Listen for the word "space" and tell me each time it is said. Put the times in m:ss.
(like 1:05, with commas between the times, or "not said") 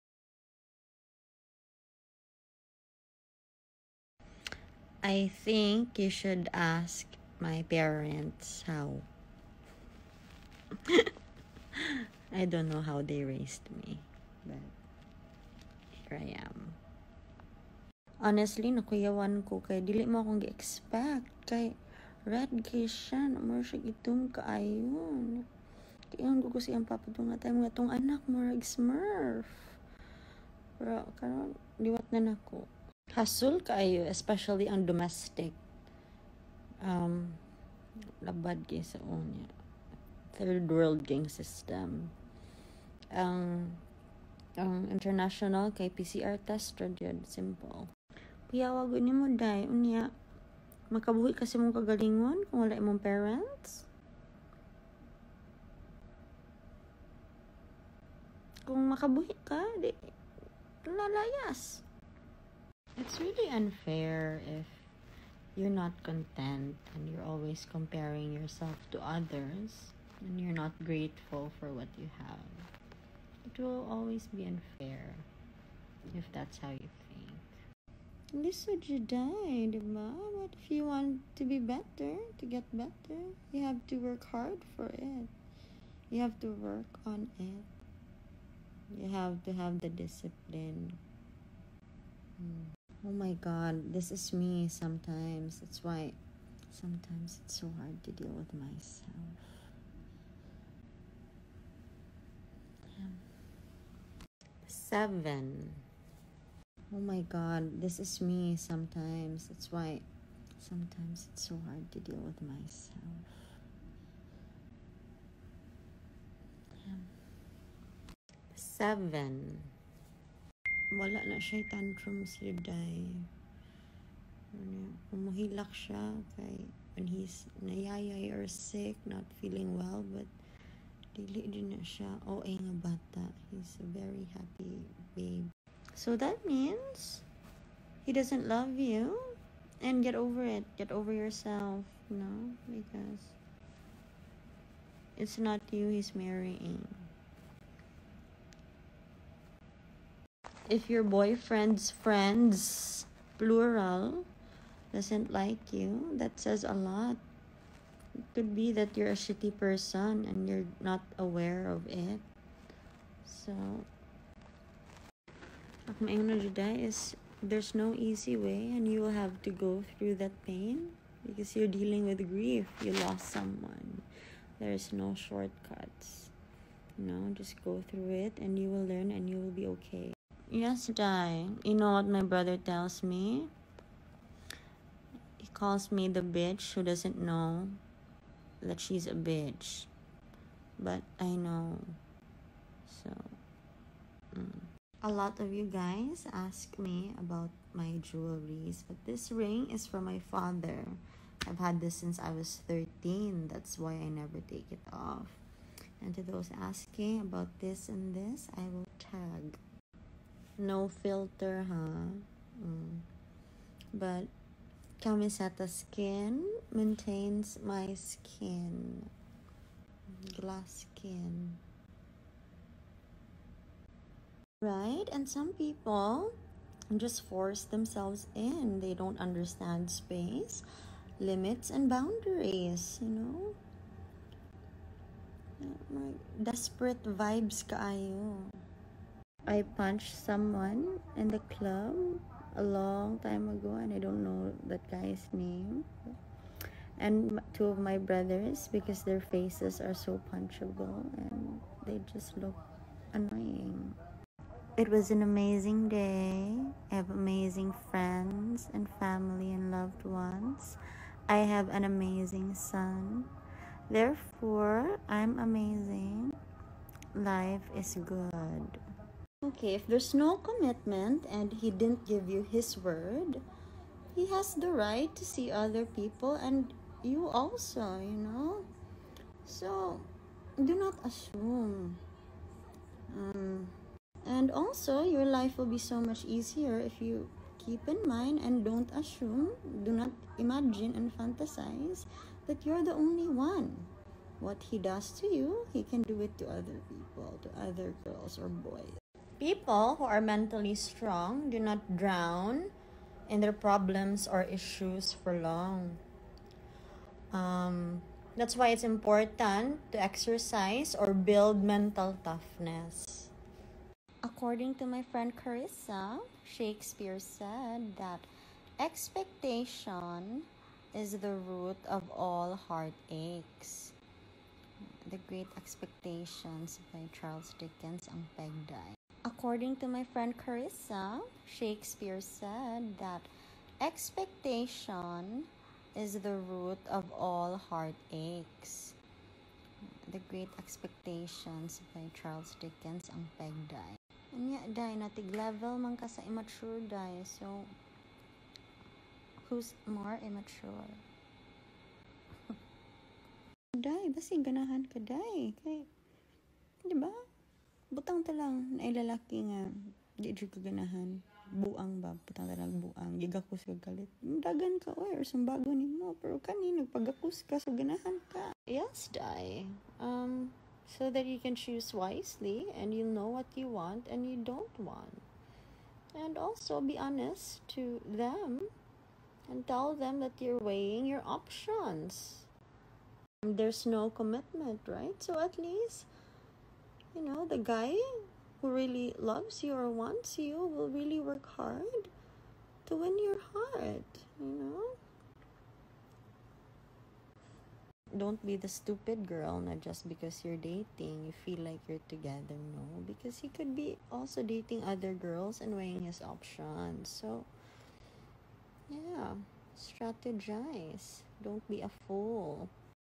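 3:49.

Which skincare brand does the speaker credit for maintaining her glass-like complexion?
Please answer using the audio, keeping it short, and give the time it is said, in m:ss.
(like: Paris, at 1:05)
Kamiseta, at 3:35.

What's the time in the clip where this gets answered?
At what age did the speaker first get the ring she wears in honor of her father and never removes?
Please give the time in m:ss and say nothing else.
3:22.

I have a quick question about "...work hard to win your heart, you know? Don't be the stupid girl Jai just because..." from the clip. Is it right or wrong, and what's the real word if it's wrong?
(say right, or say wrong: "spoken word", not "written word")
wrong: "Not", not "Jai".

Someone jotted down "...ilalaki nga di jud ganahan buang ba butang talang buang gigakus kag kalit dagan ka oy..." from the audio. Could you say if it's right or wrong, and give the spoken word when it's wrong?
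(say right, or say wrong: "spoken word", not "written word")
right.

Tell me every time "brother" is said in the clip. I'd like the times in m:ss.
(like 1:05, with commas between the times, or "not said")
3:02, 4:07.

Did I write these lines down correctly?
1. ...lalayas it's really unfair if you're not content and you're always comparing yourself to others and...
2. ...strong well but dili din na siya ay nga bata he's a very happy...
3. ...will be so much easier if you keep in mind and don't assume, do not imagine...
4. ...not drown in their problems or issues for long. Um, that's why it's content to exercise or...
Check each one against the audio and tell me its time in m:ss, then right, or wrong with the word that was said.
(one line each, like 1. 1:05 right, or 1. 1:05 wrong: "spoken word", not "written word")
1. 1:00 right
2. 2:09 wrong: "feeling", not "strong"
3. 4:45 right
4. 5:01 wrong: "important", not "content".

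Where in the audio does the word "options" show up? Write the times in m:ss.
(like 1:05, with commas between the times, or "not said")
6:21, 6:46.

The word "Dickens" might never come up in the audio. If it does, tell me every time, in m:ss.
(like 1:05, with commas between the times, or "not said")
5:27, 5:42.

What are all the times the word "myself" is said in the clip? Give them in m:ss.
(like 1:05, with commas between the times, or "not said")
1:38, 1:52.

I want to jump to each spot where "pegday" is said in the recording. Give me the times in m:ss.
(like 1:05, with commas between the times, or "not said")
5:28, 5:43.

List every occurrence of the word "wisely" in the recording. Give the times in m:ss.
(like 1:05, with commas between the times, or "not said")
6:11.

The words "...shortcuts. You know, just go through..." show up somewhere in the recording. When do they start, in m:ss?
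2:55.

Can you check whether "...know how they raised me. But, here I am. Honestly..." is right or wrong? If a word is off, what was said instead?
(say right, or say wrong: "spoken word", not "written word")
right.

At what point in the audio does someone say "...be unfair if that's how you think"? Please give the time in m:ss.
1:14.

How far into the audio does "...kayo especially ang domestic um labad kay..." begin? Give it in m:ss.
0:33.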